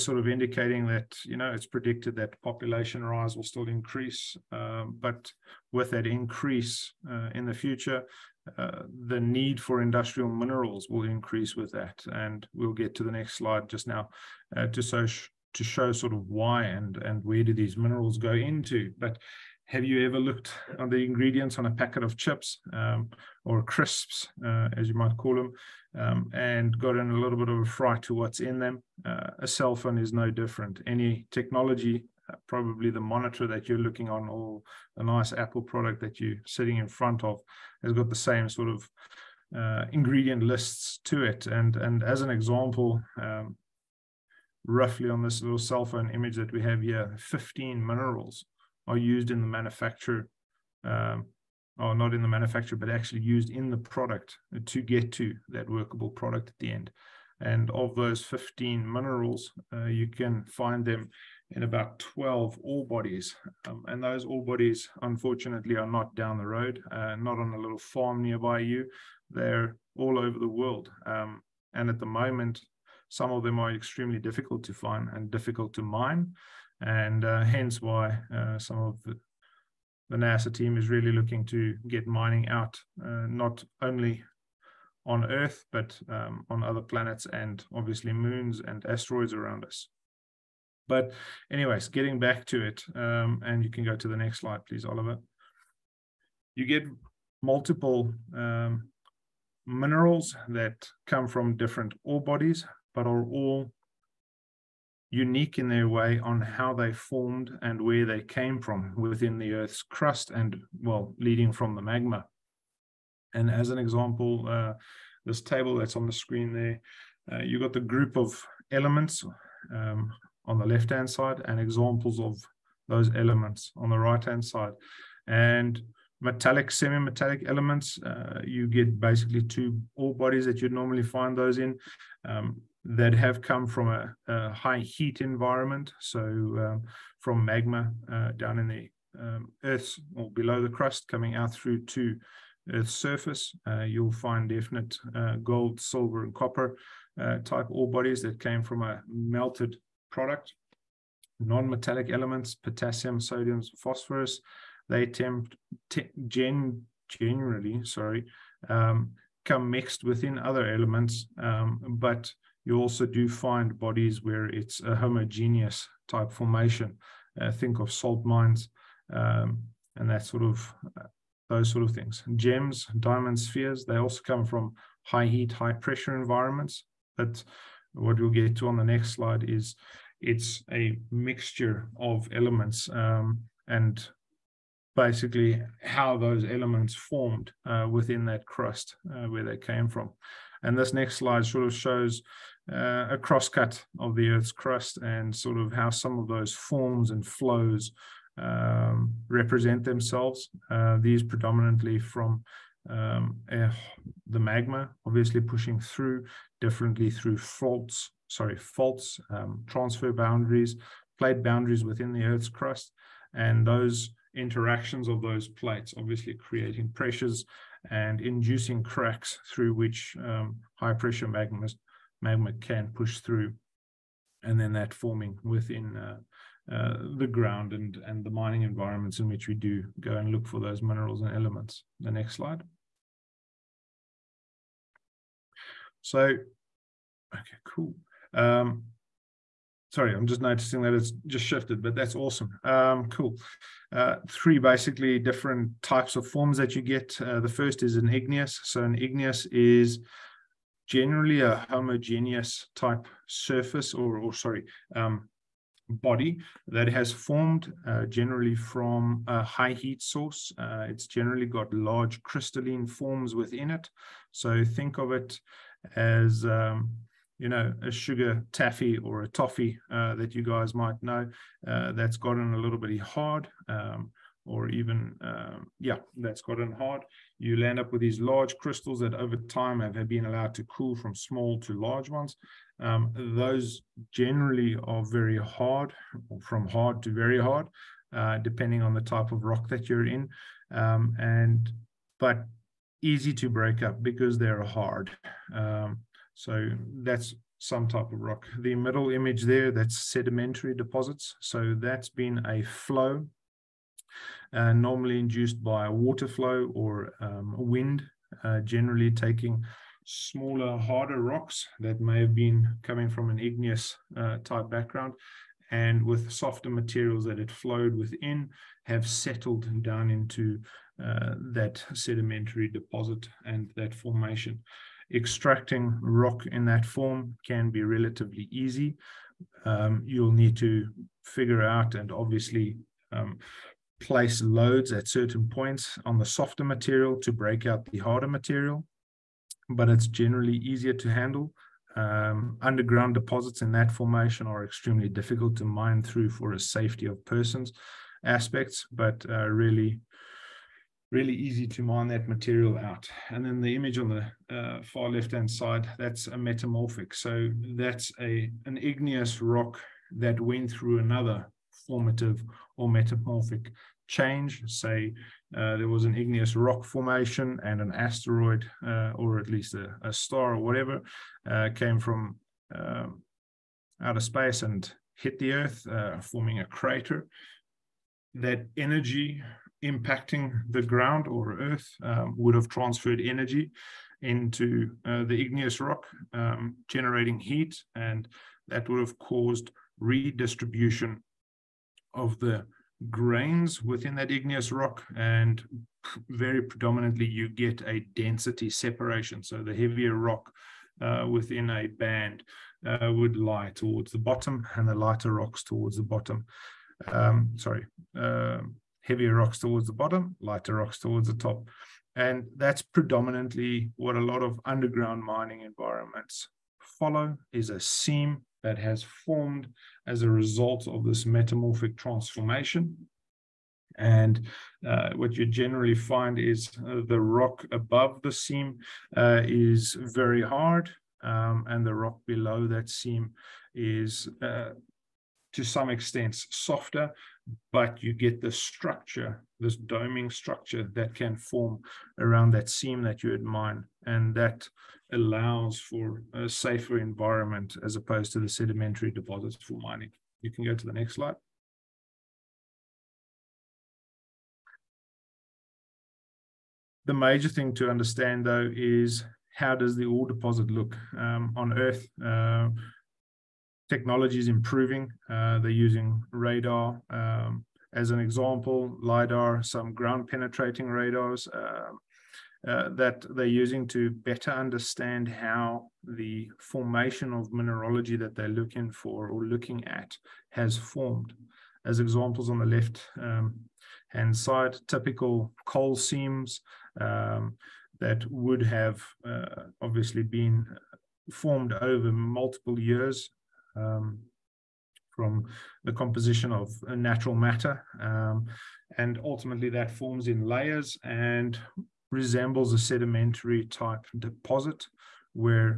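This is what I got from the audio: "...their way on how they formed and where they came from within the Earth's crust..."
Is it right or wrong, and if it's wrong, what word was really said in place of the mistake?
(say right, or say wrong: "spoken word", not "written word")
right.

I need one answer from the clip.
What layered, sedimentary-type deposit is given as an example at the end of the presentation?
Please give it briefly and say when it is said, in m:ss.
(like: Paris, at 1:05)
coal seams, at 8:05.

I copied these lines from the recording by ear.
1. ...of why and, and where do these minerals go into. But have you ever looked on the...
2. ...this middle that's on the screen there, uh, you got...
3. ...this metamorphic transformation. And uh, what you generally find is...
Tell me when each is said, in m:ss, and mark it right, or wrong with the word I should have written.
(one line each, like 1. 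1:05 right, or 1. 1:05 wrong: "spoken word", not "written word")
1. 0:16 right
2. 1:55 wrong: "table", not "middle"
3. 7:01 right.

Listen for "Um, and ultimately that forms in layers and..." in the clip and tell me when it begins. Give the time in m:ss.
8:18.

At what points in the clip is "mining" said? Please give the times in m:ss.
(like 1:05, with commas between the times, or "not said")
1:22, 3:48, 6:55, 7:29.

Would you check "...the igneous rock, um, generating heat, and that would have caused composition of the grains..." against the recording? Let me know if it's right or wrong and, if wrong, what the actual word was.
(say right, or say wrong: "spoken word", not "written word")
wrong: "redistribution", not "composition".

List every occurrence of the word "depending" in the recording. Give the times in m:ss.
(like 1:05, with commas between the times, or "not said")
4:48.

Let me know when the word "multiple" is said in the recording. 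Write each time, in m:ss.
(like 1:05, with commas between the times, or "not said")
1:37, 8:12.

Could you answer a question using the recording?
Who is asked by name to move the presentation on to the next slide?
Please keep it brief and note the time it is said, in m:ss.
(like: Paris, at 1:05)
Oliver, at 1:34.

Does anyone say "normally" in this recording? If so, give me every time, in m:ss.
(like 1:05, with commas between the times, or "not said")
2:10, 5:04.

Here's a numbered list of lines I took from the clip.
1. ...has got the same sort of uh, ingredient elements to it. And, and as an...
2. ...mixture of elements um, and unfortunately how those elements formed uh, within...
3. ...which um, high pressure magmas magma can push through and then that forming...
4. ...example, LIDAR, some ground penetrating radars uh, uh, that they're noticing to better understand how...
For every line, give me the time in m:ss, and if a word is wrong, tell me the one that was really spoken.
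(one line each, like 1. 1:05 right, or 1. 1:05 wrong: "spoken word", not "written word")
1. 0:37 wrong: "lists", not "elements"
2. 3:01 wrong: "basically", not "unfortunately"
3. 3:39 right
4. 7:48 wrong: "using", not "noticing".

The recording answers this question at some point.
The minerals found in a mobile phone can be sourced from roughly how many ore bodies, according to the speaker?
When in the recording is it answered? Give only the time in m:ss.
1:01.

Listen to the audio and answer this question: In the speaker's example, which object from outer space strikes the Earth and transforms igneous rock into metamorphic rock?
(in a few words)
an asteroid.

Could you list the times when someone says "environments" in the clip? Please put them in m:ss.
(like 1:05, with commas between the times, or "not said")
2:15, 2:56, 3:48, 6:55, 7:26.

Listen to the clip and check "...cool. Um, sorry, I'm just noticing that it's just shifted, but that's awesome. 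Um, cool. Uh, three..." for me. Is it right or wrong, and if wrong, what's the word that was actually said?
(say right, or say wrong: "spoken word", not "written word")
right.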